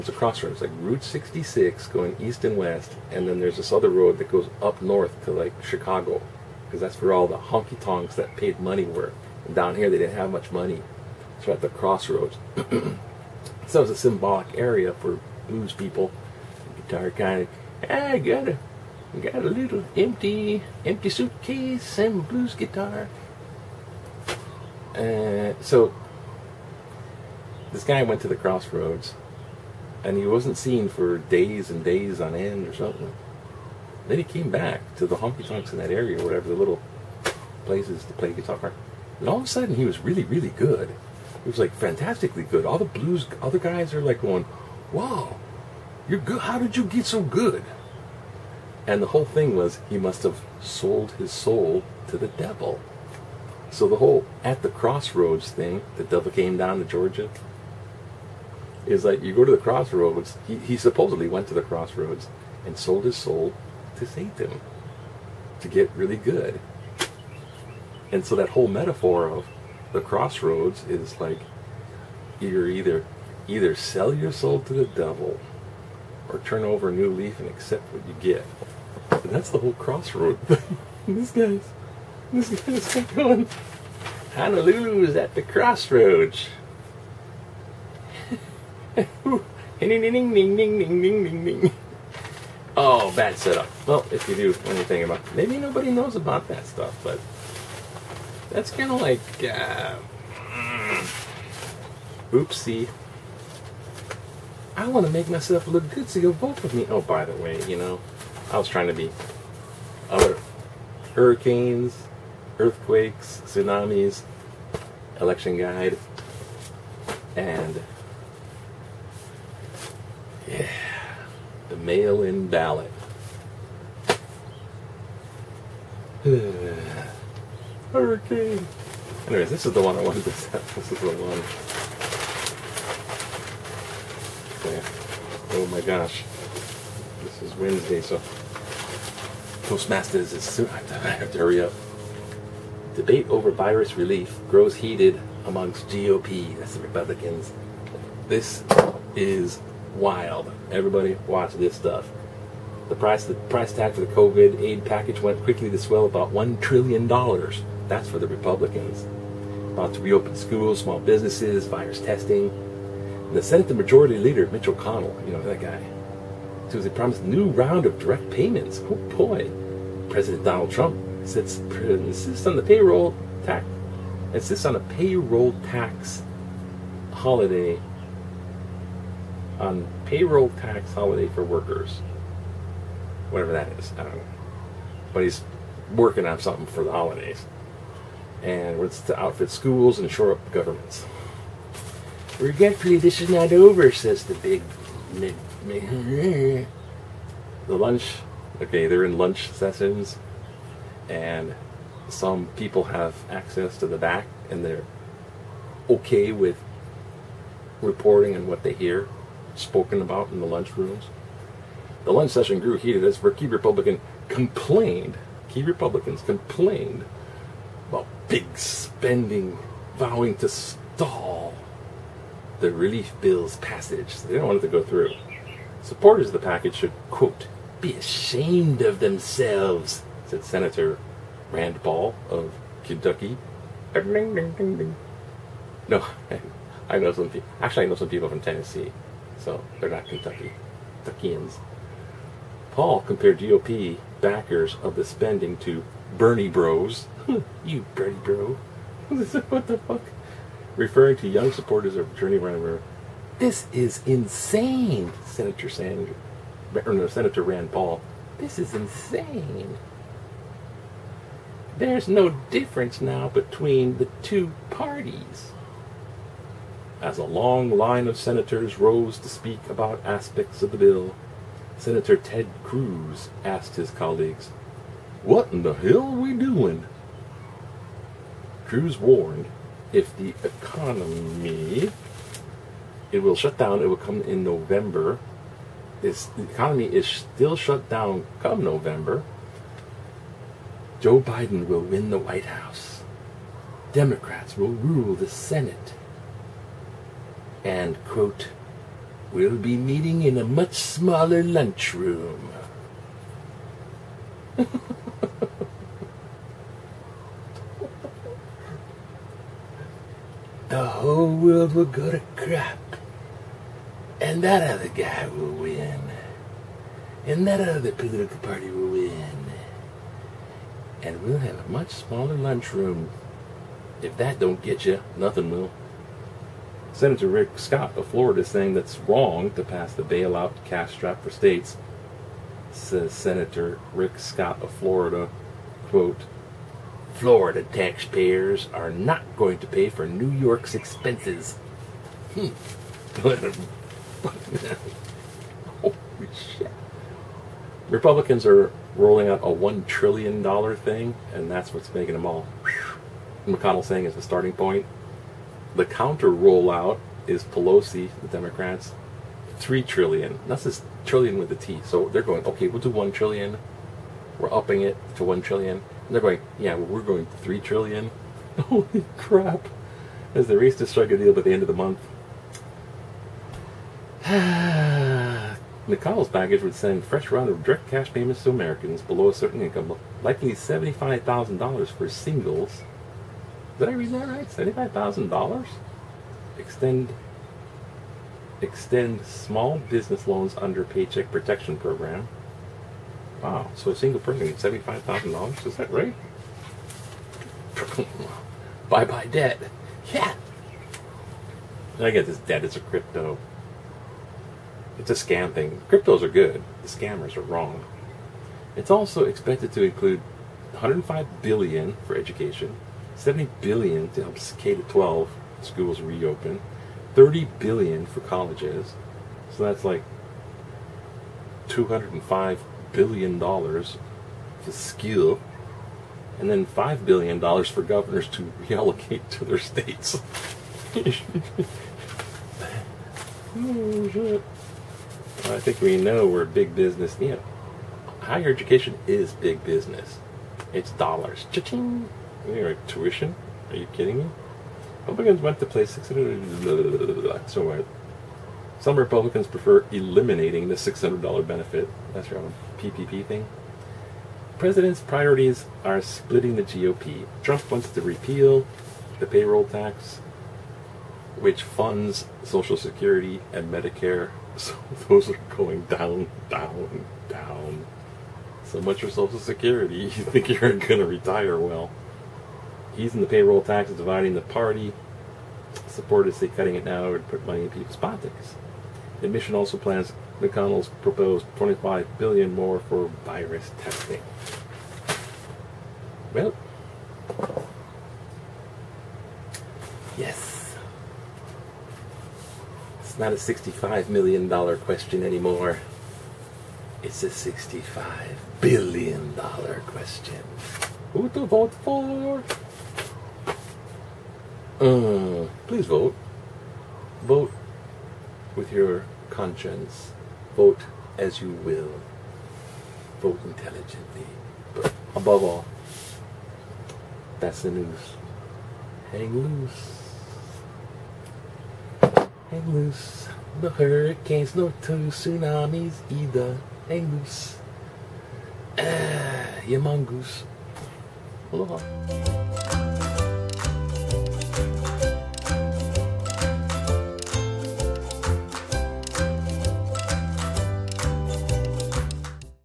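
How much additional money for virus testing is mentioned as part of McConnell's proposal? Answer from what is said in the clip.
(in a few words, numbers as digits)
25 billion.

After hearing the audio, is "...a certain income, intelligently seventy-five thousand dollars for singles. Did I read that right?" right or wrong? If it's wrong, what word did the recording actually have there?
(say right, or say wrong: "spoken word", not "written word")
wrong: "likely", not "intelligently".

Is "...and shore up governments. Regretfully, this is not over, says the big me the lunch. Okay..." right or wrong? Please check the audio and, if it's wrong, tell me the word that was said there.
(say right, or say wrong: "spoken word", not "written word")
right.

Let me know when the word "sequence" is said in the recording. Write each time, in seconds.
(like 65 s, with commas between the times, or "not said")
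not said.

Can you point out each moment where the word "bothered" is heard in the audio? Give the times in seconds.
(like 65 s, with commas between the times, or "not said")
not said.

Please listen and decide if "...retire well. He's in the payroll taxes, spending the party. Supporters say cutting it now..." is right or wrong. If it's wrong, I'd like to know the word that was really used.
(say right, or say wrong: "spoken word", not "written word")
wrong: "dividing", not "spending".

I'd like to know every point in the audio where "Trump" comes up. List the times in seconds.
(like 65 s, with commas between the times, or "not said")
170 s, 457 s.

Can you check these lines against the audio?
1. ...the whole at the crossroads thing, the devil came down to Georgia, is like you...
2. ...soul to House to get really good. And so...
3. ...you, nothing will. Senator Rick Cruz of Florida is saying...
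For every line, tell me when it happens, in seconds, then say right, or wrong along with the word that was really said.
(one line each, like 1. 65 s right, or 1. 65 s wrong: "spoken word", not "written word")
1. 53 s right
2. 63 s wrong: "Satan", not "House"
3. 324 s wrong: "Scott", not "Cruz".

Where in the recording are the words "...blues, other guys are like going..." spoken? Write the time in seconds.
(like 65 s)
42 s.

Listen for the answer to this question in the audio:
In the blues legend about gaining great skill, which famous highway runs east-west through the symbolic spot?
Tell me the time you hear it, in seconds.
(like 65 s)
0 s.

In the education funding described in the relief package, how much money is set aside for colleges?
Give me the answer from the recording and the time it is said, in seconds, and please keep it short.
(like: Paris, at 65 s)
30 billion, at 417 s.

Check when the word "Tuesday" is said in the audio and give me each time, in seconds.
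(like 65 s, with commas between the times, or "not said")
166 s.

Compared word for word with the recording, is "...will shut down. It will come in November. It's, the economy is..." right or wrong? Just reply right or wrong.
right.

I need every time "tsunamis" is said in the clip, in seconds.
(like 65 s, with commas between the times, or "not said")
113 s, 525 s.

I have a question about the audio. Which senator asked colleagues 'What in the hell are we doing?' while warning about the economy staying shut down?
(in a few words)
Ted Cruz.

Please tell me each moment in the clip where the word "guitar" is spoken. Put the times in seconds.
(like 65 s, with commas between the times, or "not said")
16 s, 22 s, 38 s.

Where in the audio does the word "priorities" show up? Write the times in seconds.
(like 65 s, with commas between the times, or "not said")
455 s.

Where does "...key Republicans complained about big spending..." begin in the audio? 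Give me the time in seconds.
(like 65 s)
215 s.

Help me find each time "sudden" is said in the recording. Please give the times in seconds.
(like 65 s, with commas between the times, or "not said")
39 s.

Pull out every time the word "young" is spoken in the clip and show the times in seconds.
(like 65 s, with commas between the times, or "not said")
251 s.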